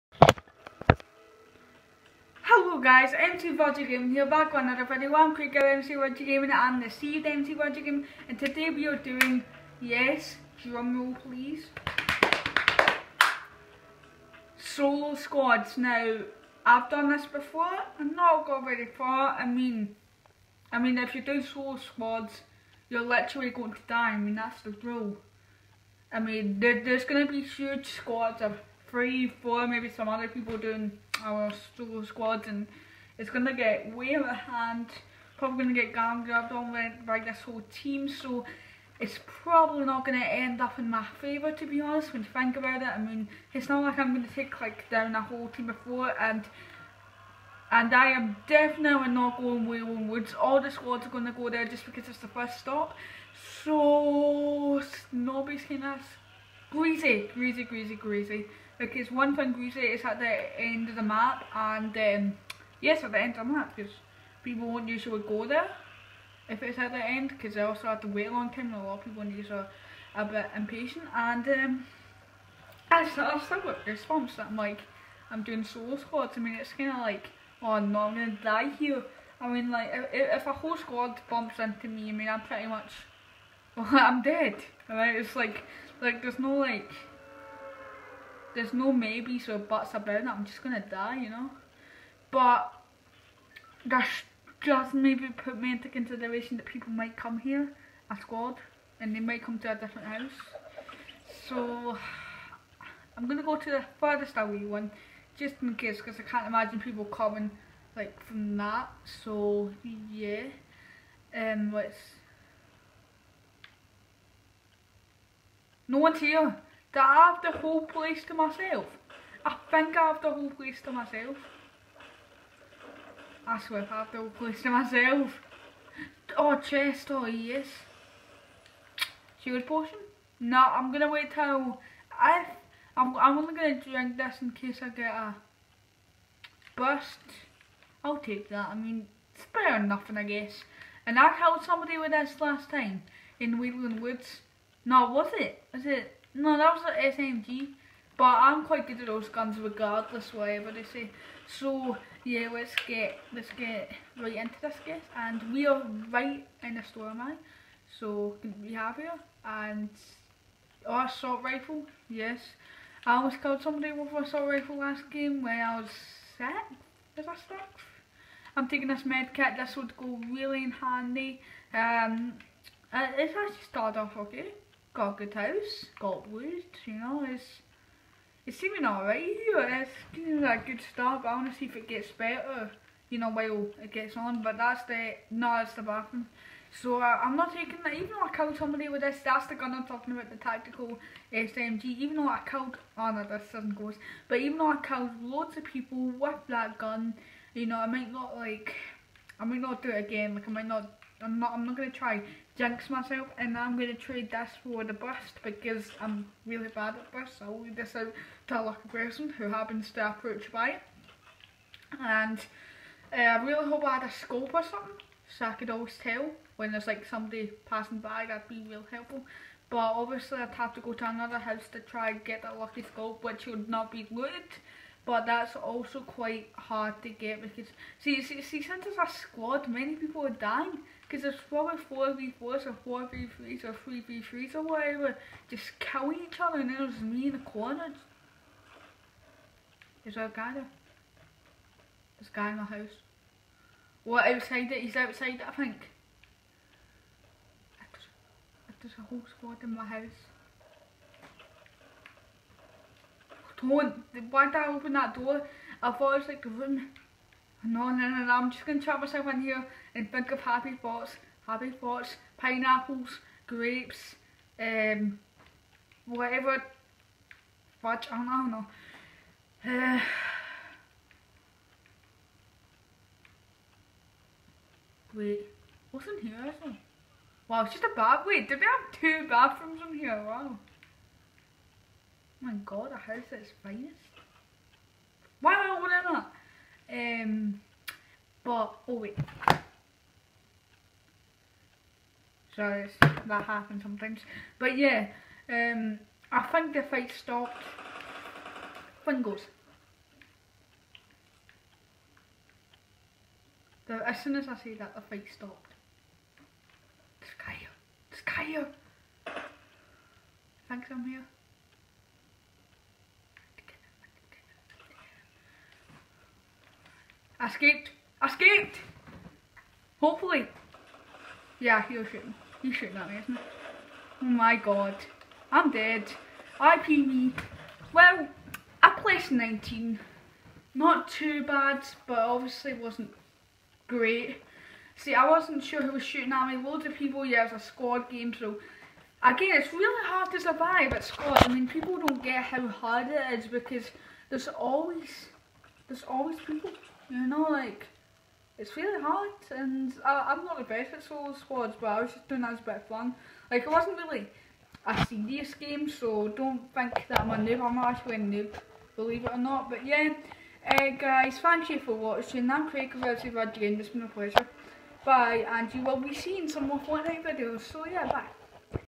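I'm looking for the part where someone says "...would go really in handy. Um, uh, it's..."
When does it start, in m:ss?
2:49.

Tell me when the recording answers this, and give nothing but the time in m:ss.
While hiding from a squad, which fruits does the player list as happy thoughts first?
4:22.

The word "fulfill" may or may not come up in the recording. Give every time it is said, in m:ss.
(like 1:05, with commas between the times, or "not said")
not said.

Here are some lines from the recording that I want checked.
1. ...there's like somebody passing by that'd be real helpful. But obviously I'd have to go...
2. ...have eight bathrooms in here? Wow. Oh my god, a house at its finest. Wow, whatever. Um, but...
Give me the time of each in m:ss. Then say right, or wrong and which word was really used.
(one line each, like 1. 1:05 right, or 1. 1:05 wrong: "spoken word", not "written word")
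1. 3:36 right
2. 4:38 wrong: "two", not "eight".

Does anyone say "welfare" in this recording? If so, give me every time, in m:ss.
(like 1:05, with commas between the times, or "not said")
not said.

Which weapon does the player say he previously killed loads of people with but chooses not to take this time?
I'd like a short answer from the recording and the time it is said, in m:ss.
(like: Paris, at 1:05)
Tactical SMG, at 3:10.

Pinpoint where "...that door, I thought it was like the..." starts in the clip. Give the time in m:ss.
4:14.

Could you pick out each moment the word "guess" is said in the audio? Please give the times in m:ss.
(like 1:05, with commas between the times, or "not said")
2:20, 2:34.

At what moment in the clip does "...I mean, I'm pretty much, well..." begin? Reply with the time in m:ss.
1:22.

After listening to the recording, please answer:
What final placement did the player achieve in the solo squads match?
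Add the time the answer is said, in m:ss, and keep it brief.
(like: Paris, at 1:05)
19, at 5:29.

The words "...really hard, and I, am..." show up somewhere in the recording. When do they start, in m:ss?
5:48.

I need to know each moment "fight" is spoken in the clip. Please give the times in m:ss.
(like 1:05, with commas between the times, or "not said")
4:56, 5:05.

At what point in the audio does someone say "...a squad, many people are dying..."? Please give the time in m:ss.
3:48.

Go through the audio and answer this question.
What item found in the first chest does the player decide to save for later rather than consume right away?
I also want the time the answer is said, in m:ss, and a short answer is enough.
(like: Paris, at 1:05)
Shield potion, at 2:09.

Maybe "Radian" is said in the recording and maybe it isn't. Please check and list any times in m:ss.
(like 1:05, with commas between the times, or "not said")
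6:03.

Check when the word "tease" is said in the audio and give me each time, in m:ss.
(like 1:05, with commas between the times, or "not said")
not said.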